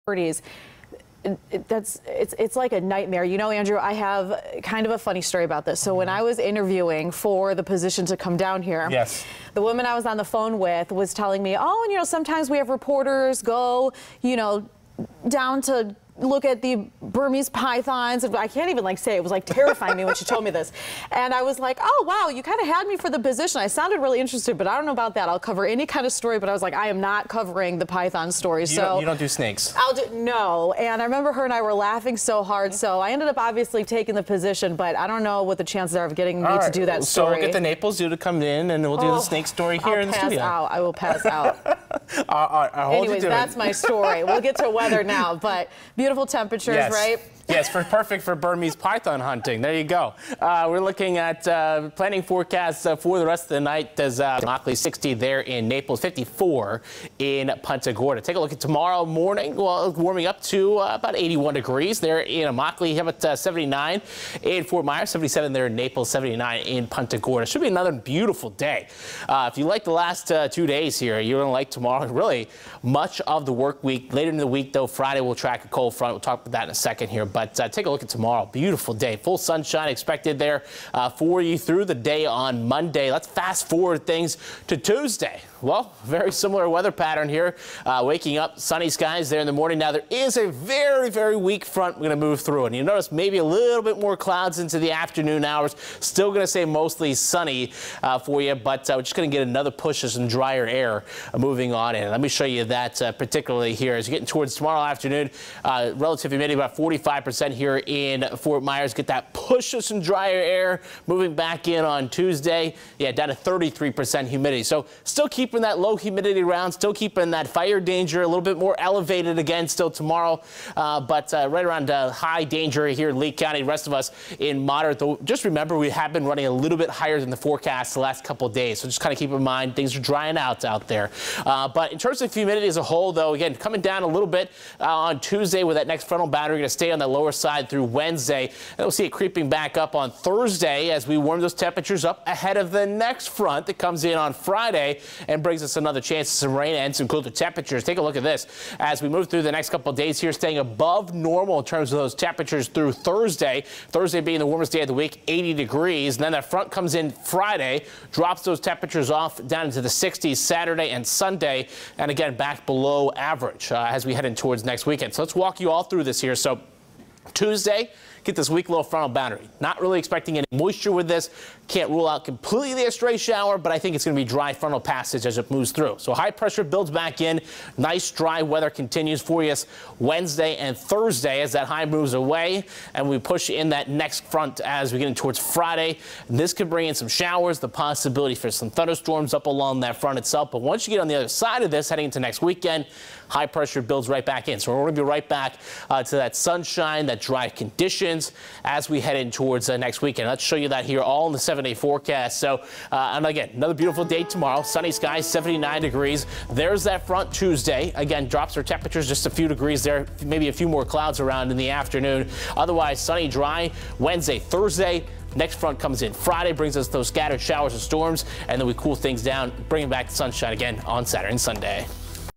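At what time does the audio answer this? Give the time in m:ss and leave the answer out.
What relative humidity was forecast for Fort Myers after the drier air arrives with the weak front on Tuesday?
1:53.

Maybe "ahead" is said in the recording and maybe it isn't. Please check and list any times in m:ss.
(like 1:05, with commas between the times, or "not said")
2:22.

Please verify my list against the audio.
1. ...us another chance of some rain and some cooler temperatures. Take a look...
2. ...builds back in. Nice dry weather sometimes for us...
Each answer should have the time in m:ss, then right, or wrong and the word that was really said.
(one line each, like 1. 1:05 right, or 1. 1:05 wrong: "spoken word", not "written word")
1. 2:25 right
2. 2:56 wrong: "continues", not "sometimes".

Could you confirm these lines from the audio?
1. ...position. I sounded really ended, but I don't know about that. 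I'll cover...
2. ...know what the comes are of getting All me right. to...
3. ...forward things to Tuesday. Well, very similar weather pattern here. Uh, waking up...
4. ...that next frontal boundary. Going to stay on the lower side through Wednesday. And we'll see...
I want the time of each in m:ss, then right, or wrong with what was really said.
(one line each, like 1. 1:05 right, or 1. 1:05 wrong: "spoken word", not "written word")
1. 0:23 wrong: "interested", not "ended"
2. 0:35 wrong: "chances", not "comes"
3. 1:23 right
4. 2:15 right.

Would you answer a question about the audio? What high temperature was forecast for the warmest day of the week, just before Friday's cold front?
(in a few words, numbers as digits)
80 degrees.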